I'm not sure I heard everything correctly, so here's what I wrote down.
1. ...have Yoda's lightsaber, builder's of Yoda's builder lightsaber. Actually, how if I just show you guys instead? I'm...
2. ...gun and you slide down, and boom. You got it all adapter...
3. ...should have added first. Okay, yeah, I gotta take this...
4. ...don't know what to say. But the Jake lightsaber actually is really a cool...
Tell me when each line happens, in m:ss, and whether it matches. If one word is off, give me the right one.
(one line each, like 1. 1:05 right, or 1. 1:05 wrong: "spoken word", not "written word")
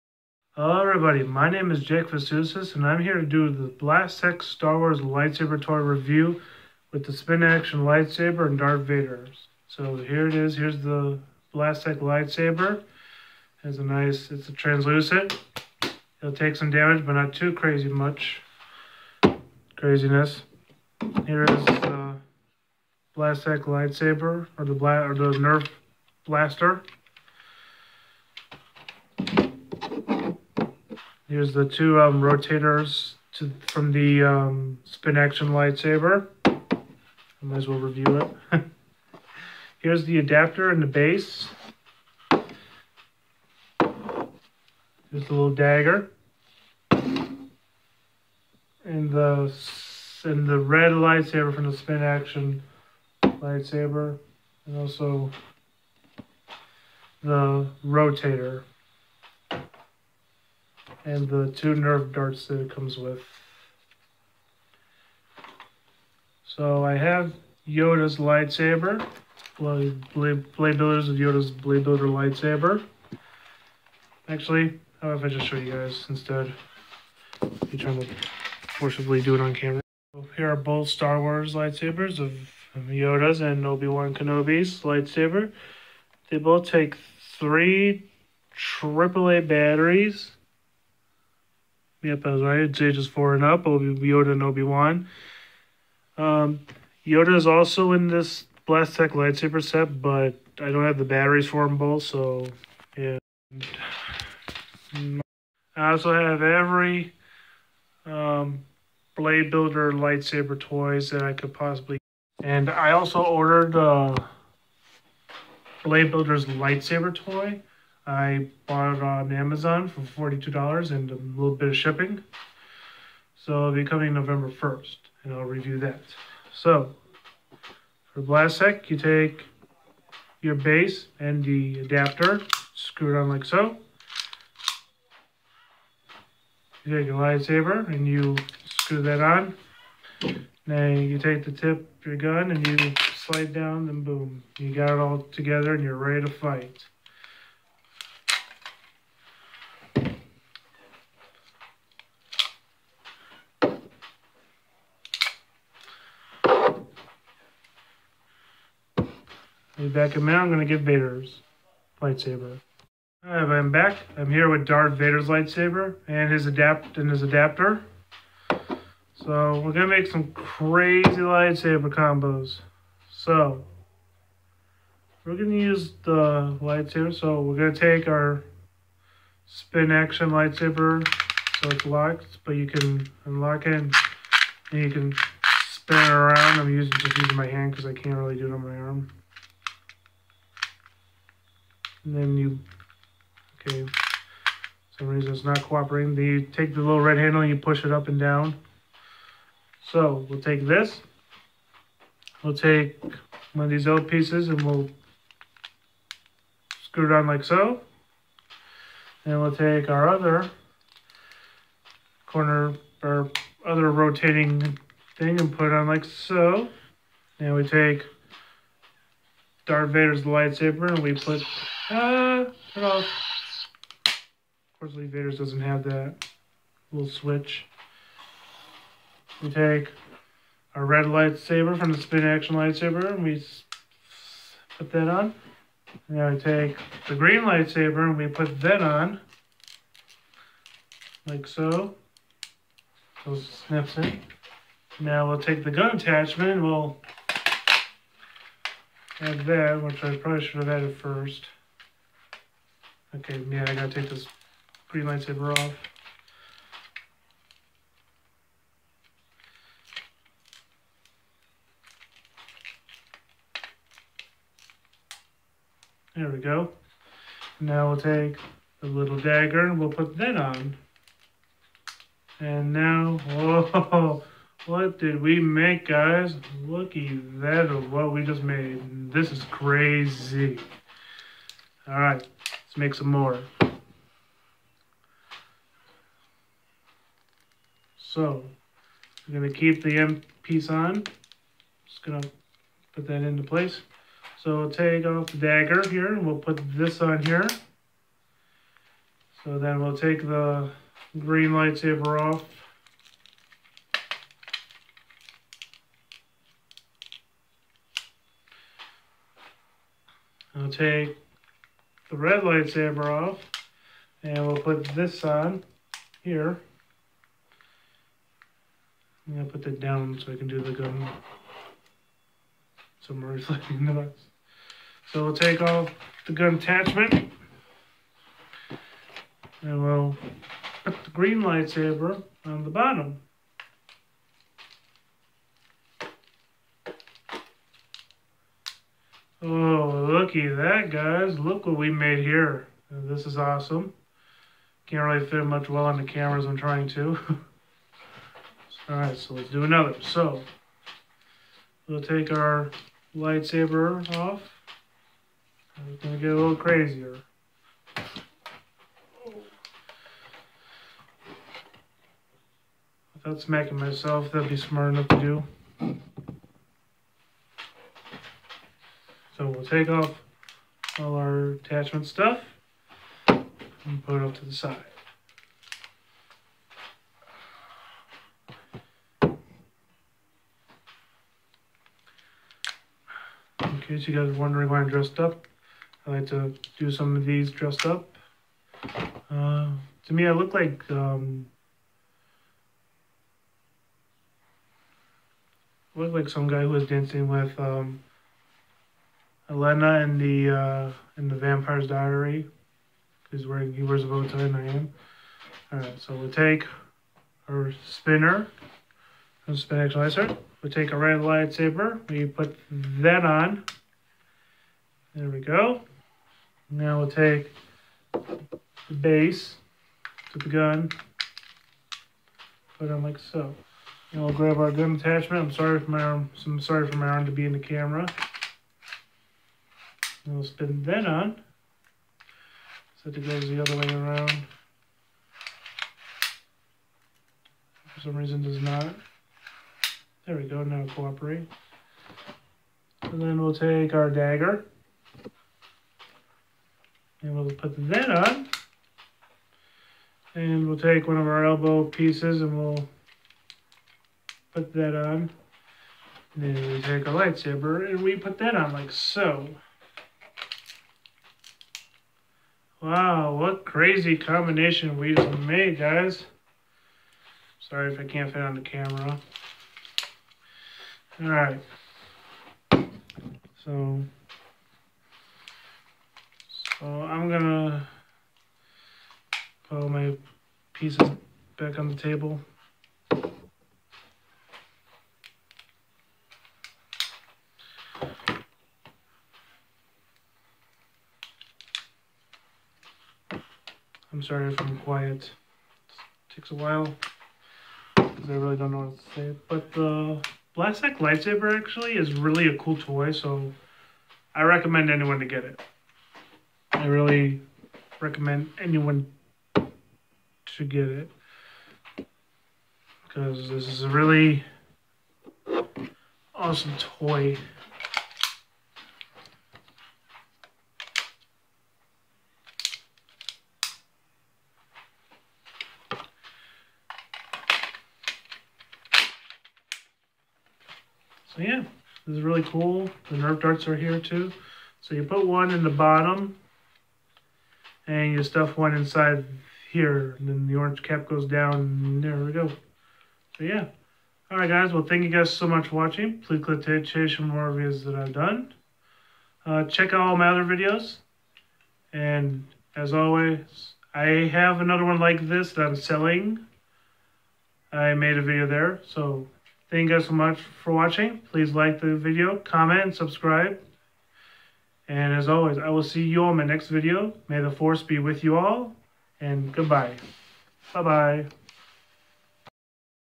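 1. 1:06 right
2. 2:22 wrong: "together", not "adapter"
3. 4:10 right
4. 8:18 wrong: "Blastech", not "Jake".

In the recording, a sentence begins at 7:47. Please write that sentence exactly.
Sorry if I can't fit on the camera.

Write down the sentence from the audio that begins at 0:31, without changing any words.
Here's the two um, rotators to, from the um, Spin Action lightsaber.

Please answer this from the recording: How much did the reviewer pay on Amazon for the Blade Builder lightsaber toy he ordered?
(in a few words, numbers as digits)
$42.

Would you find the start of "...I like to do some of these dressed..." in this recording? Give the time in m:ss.
6:26.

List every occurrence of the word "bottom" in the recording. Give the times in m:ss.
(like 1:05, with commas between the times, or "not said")
5:32, 8:55.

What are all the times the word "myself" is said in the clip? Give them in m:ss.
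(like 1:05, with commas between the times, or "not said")
6:03.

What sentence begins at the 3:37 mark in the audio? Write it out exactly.
and we take Darth Vader's lightsaber and we put uh, what else?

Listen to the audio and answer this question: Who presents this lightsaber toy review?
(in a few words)
Jake Vistucis.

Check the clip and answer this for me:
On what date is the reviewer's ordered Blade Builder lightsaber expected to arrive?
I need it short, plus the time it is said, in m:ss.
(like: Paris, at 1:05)
November 1st, at 2:04.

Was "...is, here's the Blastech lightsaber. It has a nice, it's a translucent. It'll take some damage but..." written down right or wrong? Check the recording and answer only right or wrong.
right.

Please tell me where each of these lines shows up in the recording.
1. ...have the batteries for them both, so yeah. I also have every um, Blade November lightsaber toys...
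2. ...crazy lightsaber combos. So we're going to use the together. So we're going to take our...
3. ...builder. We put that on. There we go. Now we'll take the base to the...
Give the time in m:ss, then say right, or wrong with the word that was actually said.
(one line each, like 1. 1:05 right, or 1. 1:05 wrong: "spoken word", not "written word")
1. 1:40 wrong: "Builder", not "November"
2. 2:50 wrong: "lightsaber", not "together"
3. 6:51 wrong: "lightsaber", not "builder".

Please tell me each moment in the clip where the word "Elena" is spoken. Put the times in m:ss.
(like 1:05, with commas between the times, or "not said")
6:39.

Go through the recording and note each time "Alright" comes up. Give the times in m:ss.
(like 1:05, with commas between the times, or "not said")
2:43, 7:51, 9:04.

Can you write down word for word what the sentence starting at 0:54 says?
And also the rotator and the two Nerf darts that it comes with.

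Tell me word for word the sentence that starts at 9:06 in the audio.
Please click to chase for more videos that I've done.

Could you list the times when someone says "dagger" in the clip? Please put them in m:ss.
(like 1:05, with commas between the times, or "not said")
0:45, 4:29, 4:55, 7:24.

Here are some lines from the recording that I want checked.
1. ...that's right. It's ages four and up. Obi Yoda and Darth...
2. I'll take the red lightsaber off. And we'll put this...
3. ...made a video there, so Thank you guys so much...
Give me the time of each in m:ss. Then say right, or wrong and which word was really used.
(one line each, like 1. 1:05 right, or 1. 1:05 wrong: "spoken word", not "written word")
1. 1:32 wrong: "Obi", not "Darth"
2. 5:10 right
3. 9:17 right.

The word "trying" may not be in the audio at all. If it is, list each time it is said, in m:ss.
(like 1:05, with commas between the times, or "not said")
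1:17, 5:46.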